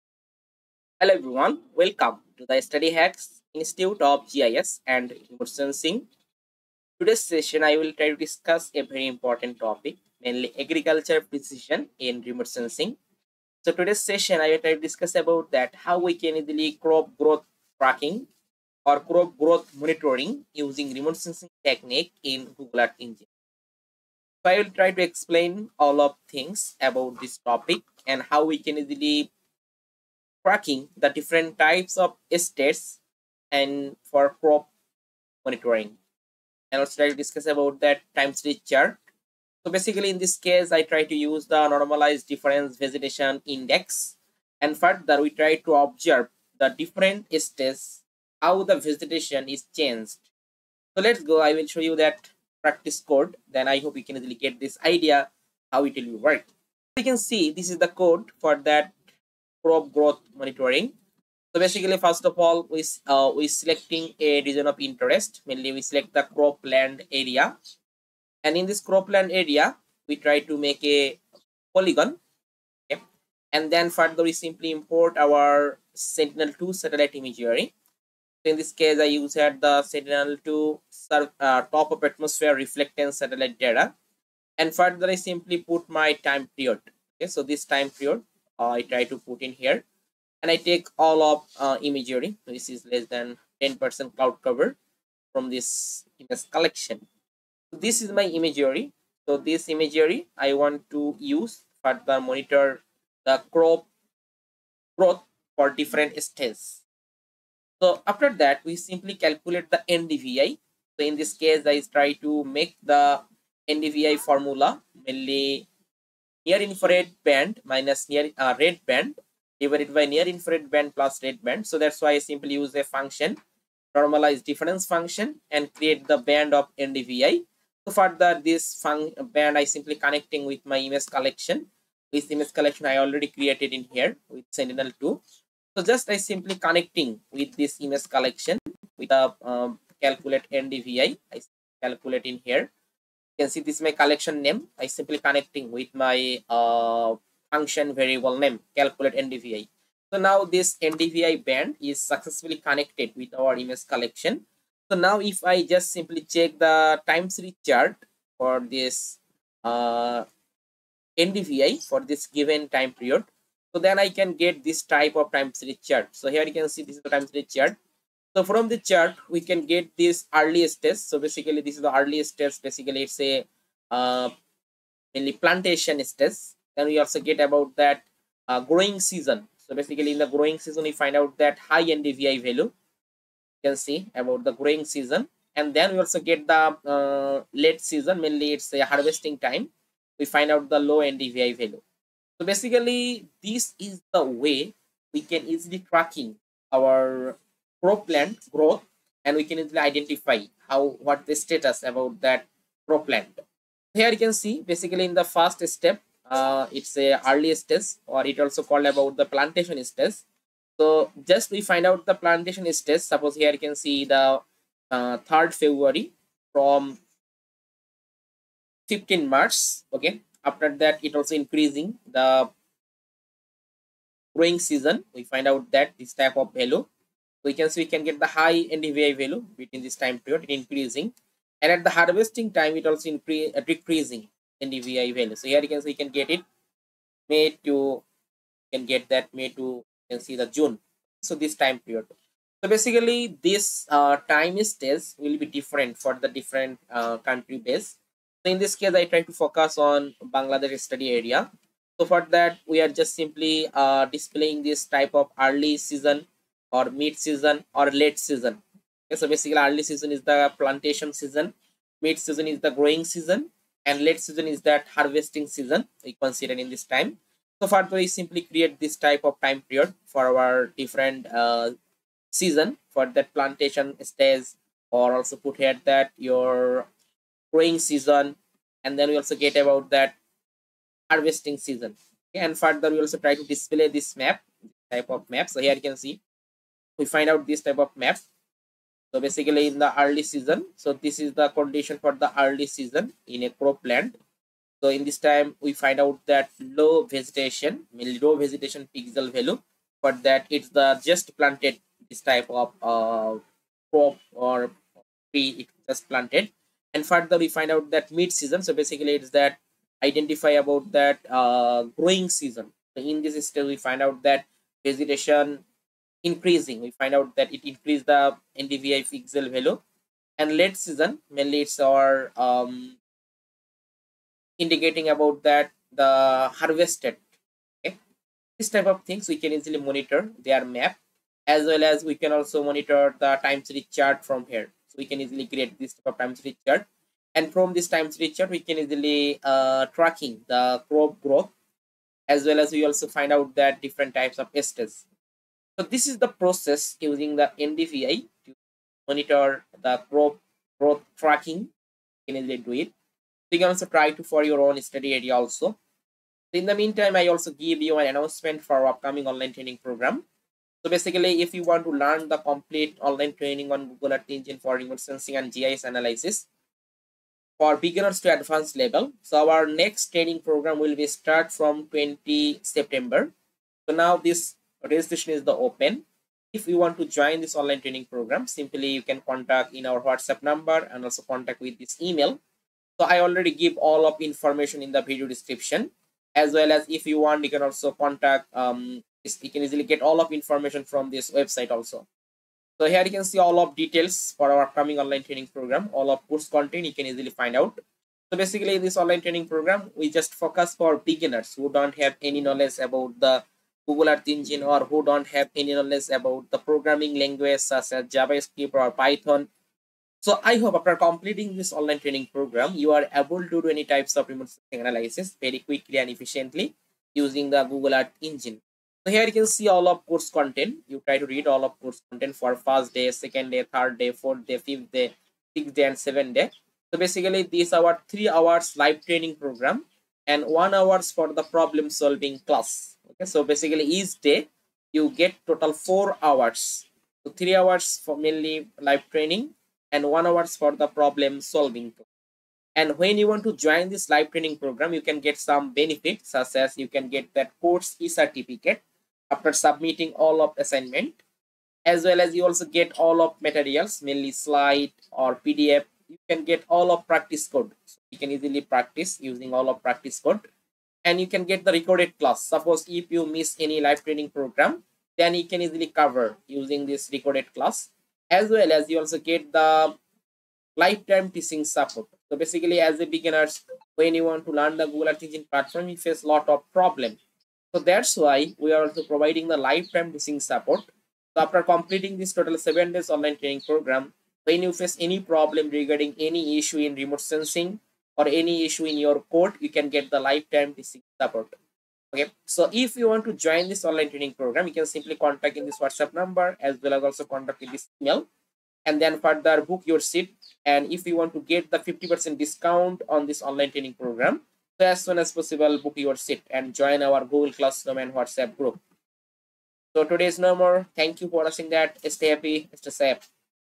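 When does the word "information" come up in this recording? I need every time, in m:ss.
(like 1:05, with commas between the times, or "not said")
6:24, 6:30.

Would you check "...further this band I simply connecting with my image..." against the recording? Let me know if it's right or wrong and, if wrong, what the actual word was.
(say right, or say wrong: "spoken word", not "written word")
right.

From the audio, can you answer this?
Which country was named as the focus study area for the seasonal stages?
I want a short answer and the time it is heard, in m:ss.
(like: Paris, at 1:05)
Bangladesh, at 4:10.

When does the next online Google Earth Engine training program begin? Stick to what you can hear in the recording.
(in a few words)
20 September.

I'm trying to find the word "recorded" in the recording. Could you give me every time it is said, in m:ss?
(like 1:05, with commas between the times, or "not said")
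7:41, 7:47.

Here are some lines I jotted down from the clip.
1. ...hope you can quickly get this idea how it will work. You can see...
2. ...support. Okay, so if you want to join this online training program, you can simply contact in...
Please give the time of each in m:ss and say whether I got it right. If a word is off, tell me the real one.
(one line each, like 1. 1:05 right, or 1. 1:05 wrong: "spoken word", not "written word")
1. 0:53 wrong: "easily", not "quickly"
2. 8:11 right.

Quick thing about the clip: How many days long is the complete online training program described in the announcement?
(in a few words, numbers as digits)
7.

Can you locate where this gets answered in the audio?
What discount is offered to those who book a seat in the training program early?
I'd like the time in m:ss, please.
8:21.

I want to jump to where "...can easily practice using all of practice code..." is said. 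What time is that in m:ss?
7:38.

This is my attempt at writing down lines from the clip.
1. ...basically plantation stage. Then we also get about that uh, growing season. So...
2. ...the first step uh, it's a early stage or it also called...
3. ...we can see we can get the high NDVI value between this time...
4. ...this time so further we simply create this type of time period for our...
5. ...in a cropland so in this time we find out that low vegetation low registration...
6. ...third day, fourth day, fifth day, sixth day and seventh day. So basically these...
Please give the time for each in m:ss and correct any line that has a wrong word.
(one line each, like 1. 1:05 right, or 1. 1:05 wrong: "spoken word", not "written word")
1. 2:55 wrong: "mainly", not "basically"
2. 3:25 right
3. 3:47 right
4. 4:26 right
5. 4:53 wrong: "vegetation", not "registration"
6. 7:03 right.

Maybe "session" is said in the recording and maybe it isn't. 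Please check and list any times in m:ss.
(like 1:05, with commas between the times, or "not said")
0:07, 0:13.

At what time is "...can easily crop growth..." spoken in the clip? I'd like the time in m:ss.
0:16.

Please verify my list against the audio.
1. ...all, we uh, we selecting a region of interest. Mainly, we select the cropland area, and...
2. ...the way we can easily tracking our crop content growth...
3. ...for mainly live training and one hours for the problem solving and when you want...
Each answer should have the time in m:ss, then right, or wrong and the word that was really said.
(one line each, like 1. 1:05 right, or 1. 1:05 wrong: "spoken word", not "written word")
1. 1:02 right
2. 3:14 wrong: "plant", not "content"
3. 7:18 right.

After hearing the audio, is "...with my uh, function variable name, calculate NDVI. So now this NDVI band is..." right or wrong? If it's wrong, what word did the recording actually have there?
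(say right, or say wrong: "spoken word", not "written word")
right.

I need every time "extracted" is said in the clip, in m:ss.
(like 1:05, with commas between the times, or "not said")
not said.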